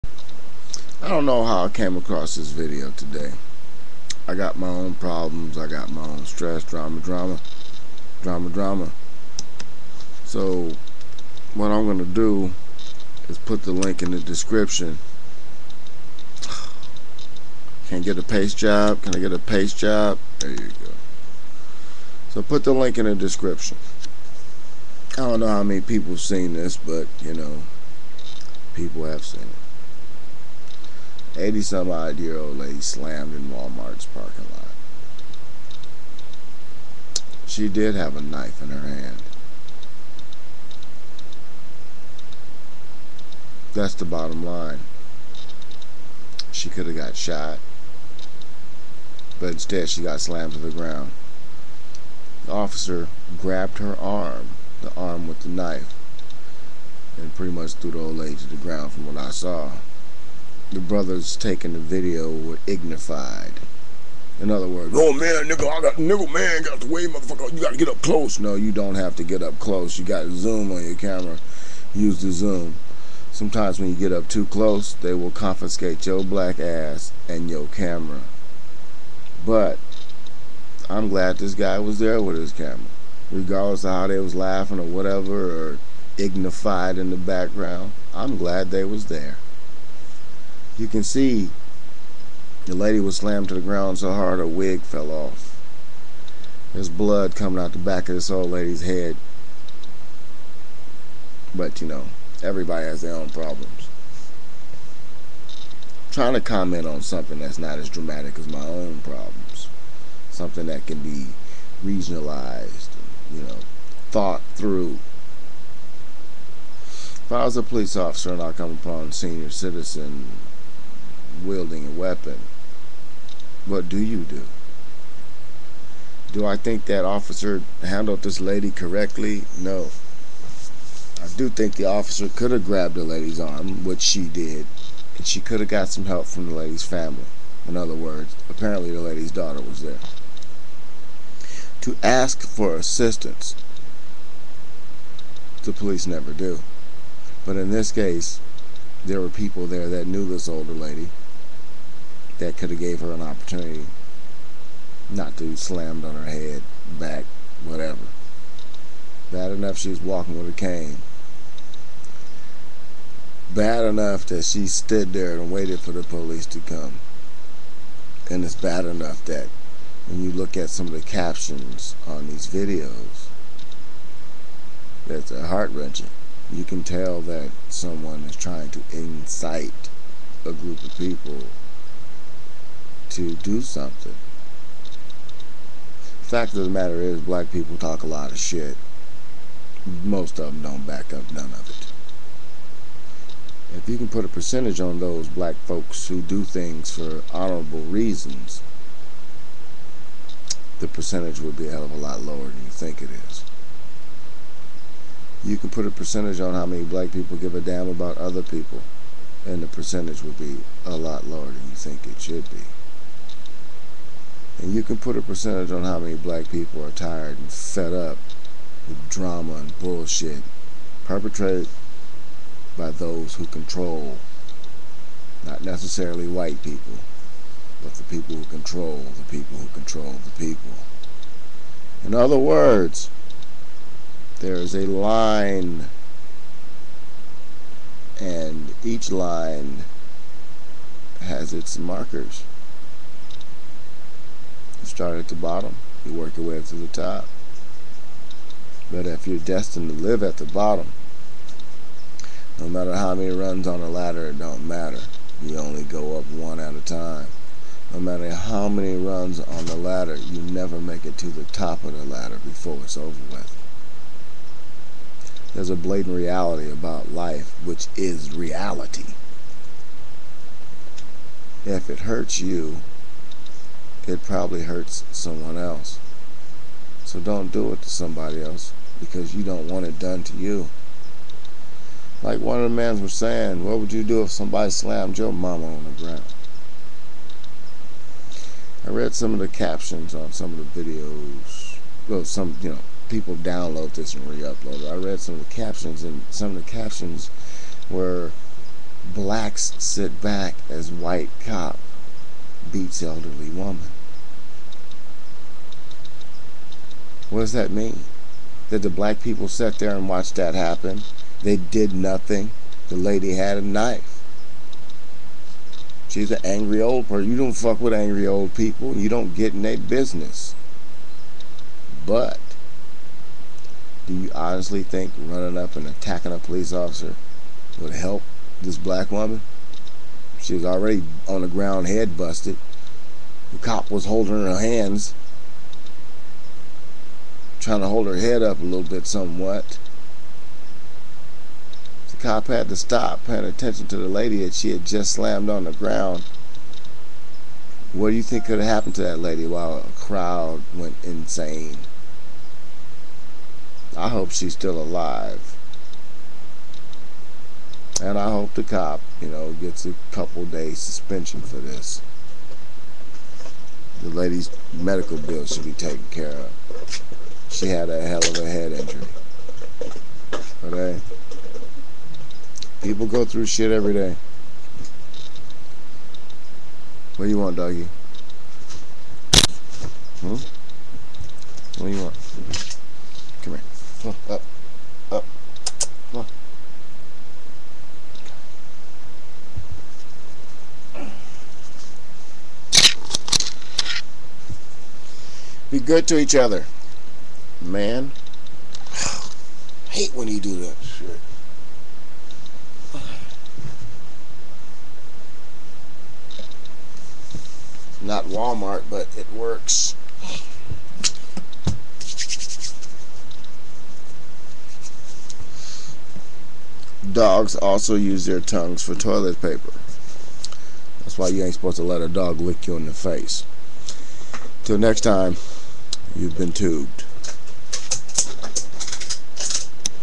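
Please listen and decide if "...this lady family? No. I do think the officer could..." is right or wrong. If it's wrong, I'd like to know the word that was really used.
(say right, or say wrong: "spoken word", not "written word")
wrong: "correctly", not "family".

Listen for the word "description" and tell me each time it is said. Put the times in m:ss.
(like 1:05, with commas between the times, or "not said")
0:14, 0:23.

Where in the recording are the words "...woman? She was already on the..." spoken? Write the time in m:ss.
5:29.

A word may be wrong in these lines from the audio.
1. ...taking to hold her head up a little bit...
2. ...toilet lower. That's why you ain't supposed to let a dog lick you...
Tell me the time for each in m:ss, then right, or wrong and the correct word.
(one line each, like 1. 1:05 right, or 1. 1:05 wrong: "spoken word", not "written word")
1. 5:37 wrong: "trying", not "taking"
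2. 6:58 wrong: "paper", not "lower".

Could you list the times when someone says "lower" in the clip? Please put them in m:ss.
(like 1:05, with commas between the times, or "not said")
3:22, 3:31.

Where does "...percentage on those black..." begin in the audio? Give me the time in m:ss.
3:14.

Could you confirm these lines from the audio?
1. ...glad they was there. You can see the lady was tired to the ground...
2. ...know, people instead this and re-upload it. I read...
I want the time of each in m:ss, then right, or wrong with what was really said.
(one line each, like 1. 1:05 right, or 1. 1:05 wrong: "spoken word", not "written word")
1. 1:28 wrong: "slammed", not "tired"
2. 4:52 wrong: "download", not "instead".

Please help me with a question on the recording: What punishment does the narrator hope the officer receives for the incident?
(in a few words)
A couple days suspension.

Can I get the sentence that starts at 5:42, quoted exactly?
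The cop had to stop, paying attention to the lady that she had just slammed on the ground.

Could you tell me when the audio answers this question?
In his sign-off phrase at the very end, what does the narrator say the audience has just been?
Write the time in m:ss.
7:06.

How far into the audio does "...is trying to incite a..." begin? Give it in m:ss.
2:58.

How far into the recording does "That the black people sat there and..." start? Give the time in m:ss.
5:08.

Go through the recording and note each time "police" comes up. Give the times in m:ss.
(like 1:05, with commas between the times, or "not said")
1:57, 2:25, 2:46, 5:26.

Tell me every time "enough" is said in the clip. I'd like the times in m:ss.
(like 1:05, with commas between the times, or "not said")
2:39, 2:43, 2:48.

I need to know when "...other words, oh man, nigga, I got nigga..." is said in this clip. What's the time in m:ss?
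1:04.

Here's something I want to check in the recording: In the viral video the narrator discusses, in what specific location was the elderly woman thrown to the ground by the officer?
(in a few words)
Walmart's parking lot.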